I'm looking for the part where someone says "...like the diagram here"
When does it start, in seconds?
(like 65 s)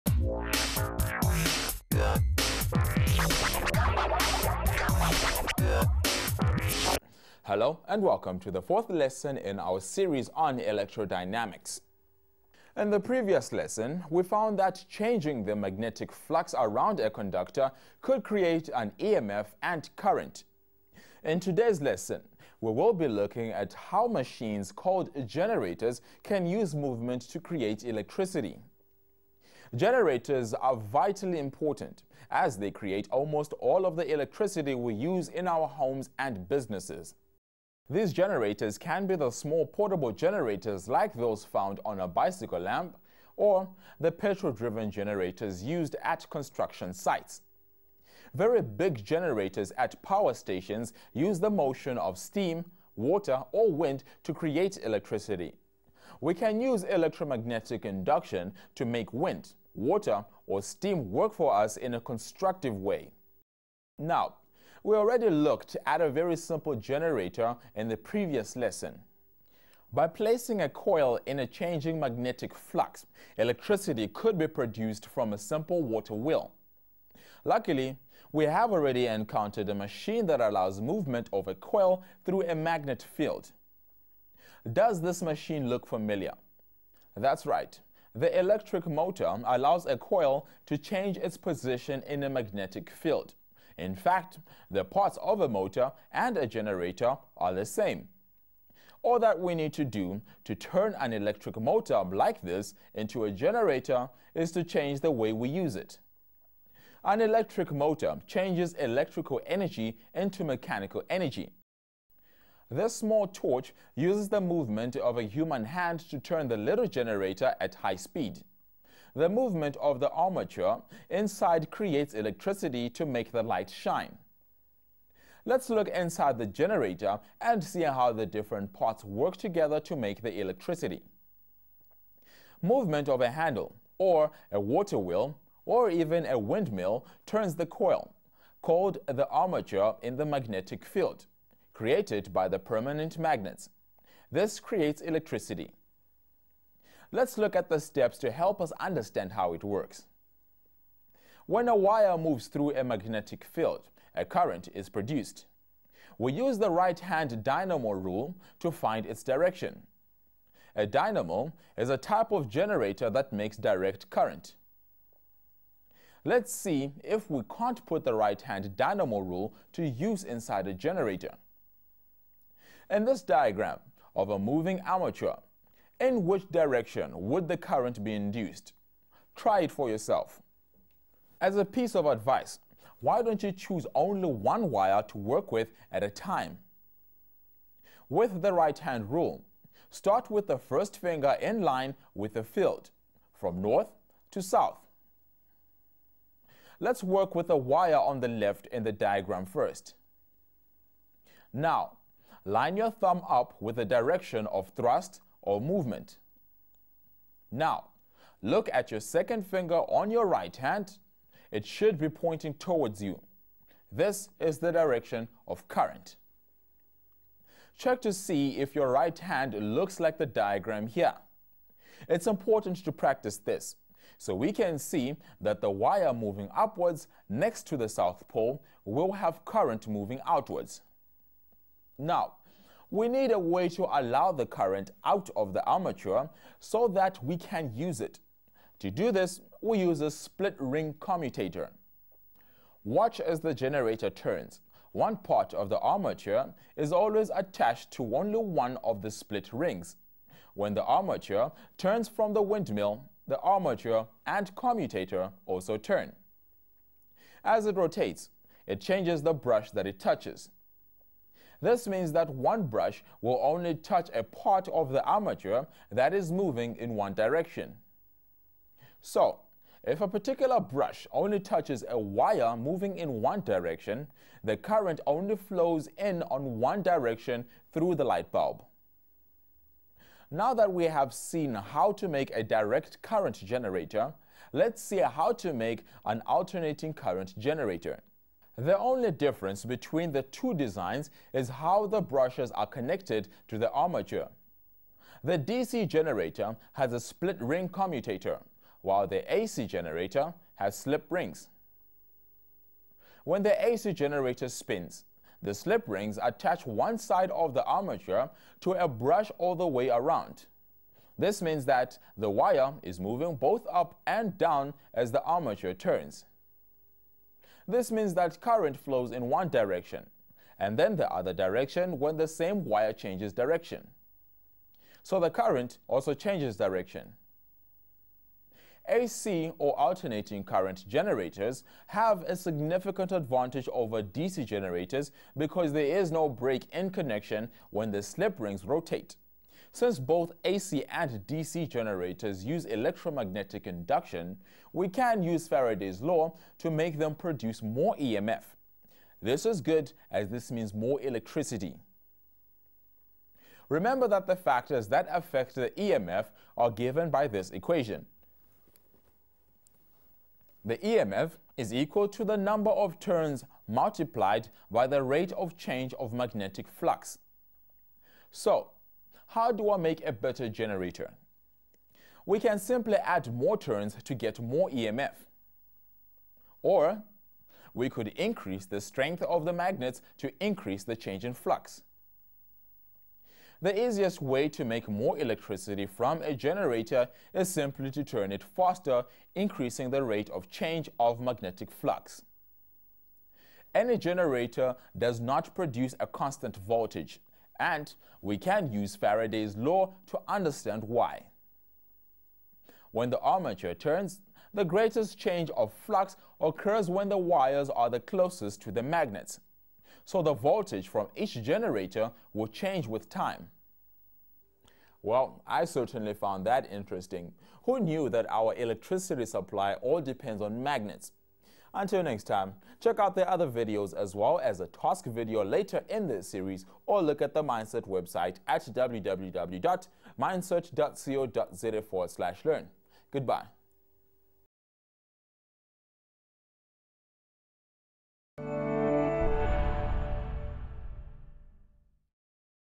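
219 s.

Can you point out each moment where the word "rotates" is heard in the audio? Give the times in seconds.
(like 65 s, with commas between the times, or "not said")
257 s, 338 s.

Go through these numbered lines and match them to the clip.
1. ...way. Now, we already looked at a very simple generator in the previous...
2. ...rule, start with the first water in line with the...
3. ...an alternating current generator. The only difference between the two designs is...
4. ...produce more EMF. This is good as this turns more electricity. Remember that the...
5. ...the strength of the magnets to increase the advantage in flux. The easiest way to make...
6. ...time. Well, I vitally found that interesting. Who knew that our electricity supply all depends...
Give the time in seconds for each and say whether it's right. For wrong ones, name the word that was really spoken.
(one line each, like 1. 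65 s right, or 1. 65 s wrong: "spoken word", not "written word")
1. 62 s right
2. 189 s wrong: "finger", not "water"
3. 286 s right
4. 347 s wrong: "means", not "turns"
5. 378 s wrong: "change", not "advantage"
6. 413 s wrong: "certainly", not "vitally".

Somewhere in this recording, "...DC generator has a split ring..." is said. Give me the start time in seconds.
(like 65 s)
295 s.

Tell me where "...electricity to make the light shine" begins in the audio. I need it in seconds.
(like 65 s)
122 s.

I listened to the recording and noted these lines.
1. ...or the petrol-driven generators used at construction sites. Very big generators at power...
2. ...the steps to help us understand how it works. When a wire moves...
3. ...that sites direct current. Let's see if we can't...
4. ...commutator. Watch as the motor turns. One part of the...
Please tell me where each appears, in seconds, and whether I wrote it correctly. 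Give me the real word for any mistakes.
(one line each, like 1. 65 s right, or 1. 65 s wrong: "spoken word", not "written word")
1. 43 s right
2. 147 s right
3. 163 s wrong: "makes", not "sites"
4. 240 s wrong: "generator", not "motor".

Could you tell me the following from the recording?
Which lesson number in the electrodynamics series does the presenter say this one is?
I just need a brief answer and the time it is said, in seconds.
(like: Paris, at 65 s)
fourth, at 8 s.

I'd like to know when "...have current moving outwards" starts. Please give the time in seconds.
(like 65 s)
229 s.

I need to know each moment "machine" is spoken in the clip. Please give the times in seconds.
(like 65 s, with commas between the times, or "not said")
24 s, 79 s, 85 s.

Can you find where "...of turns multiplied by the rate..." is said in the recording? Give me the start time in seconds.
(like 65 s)
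362 s.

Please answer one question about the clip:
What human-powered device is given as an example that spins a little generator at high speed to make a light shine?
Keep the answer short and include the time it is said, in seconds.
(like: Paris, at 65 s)
small torch, at 112 s.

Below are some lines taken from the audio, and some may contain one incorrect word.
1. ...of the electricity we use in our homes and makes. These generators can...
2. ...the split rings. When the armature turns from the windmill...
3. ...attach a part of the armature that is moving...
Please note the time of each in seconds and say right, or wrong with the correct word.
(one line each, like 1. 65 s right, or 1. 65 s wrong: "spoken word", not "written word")
1. 33 s wrong: "businesses", not "makes"
2. 249 s right
3. 263 s wrong: "touch", not "attach".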